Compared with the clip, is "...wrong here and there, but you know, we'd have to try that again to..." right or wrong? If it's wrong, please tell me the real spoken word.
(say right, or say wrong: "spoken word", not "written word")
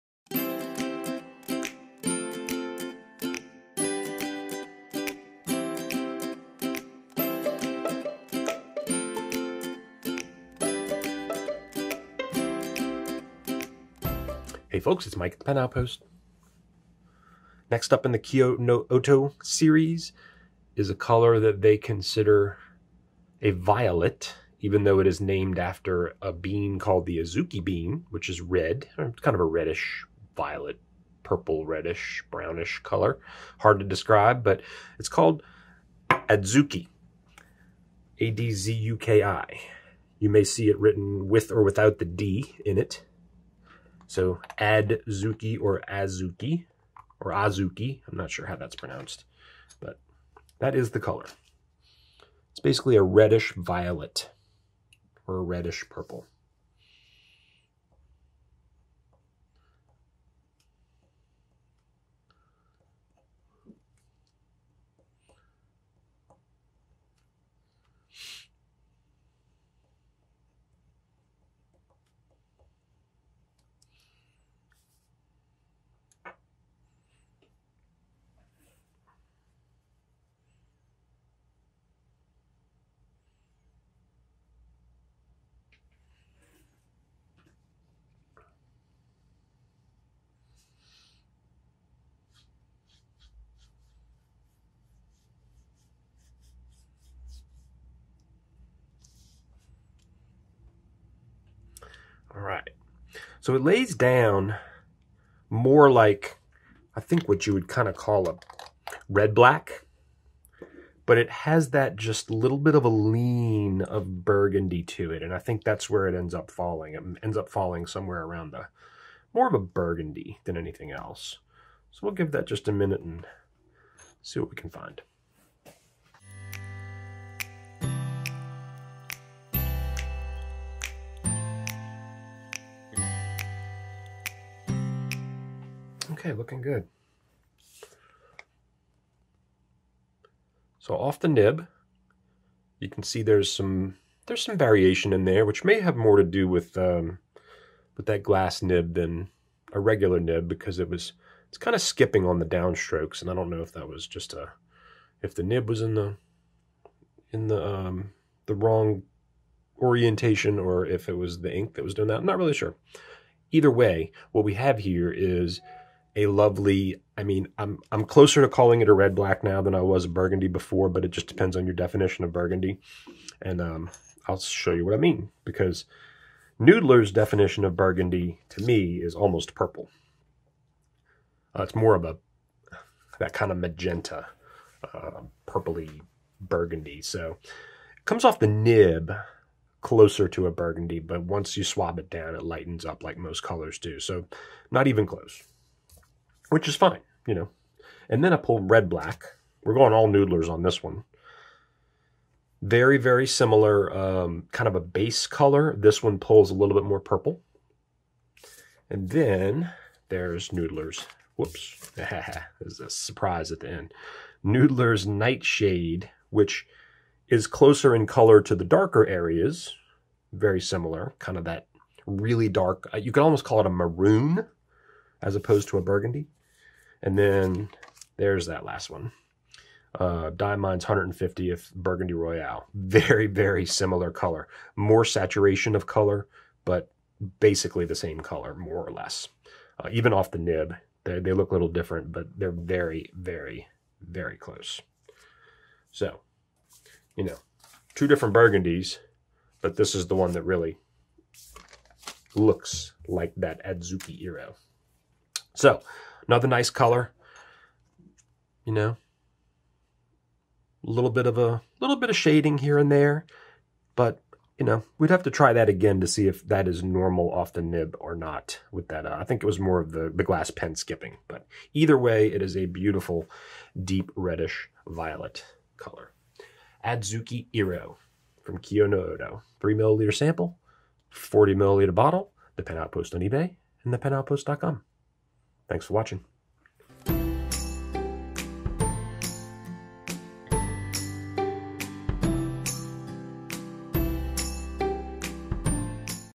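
wrong: "shading", not "wrong".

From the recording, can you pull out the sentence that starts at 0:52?
It's basically a reddish violet or a reddish purple.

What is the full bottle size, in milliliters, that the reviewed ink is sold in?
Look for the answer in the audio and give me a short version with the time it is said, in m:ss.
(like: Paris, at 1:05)
40 ml, at 4:41.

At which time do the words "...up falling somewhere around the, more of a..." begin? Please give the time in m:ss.
1:57.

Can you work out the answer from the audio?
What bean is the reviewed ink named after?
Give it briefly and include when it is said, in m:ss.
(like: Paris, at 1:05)
Azuki bean, at 0:27.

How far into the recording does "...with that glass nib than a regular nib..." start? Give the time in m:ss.
2:27.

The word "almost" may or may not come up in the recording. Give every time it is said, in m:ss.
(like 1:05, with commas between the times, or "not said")
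2:59, 3:43.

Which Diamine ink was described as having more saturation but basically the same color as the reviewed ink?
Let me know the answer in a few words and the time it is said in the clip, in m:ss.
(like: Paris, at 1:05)
150th Burgundy Royale, at 3:50.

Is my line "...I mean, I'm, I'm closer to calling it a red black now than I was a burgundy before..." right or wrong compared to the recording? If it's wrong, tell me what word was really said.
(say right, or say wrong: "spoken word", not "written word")
right.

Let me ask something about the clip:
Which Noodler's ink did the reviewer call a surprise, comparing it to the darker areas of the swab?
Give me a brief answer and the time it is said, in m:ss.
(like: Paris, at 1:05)
Nightshade, at 3:35.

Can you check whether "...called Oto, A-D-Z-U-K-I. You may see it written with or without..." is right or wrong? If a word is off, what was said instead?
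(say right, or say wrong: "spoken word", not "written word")
wrong: "Adzuki", not "Oto".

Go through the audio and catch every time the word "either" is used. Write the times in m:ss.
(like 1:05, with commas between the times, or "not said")
2:43, 4:31.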